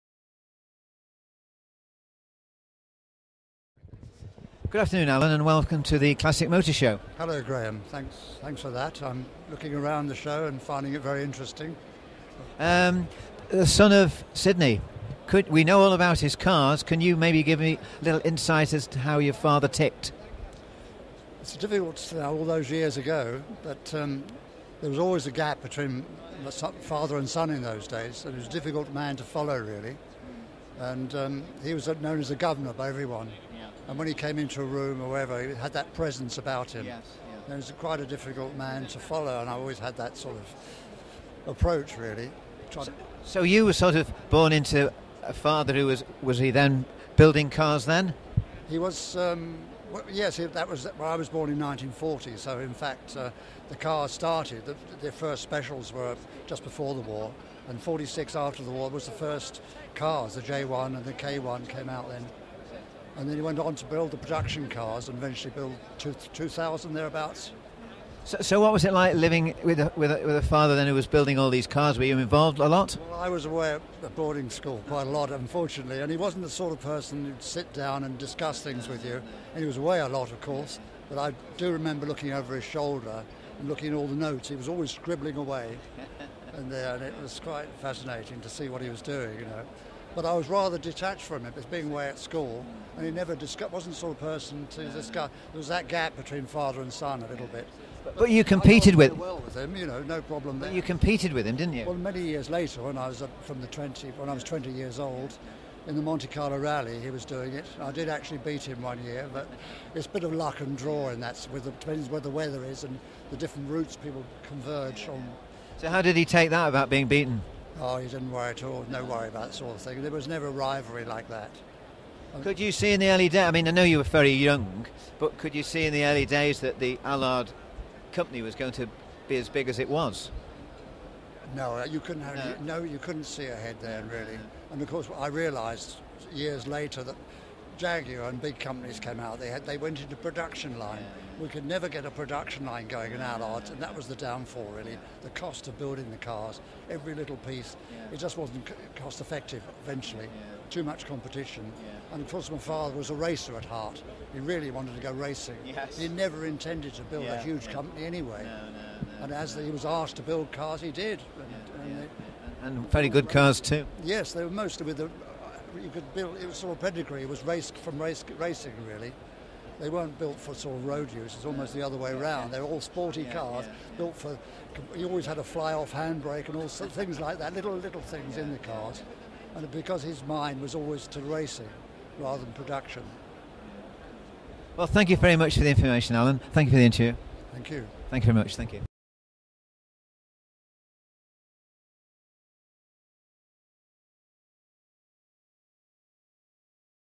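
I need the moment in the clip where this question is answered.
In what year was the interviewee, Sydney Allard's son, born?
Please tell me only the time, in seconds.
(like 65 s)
51 s.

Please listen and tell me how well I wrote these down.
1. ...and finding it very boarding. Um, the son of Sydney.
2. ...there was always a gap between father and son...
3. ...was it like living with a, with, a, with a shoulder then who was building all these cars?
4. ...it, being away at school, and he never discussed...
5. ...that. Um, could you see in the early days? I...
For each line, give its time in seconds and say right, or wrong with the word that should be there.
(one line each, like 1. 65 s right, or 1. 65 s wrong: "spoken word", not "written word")
1. 10 s wrong: "interesting", not "boarding"
2. 24 s right
3. 68 s wrong: "father", not "shoulder"
4. 91 s right
5. 121 s right.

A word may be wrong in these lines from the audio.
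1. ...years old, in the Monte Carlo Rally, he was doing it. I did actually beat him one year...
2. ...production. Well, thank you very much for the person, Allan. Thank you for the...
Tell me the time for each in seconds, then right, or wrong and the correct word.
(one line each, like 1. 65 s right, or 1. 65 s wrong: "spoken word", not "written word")
1. 104 s right
2. 182 s wrong: "information", not "person".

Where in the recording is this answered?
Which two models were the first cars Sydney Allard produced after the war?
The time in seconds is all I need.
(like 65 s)
60 s.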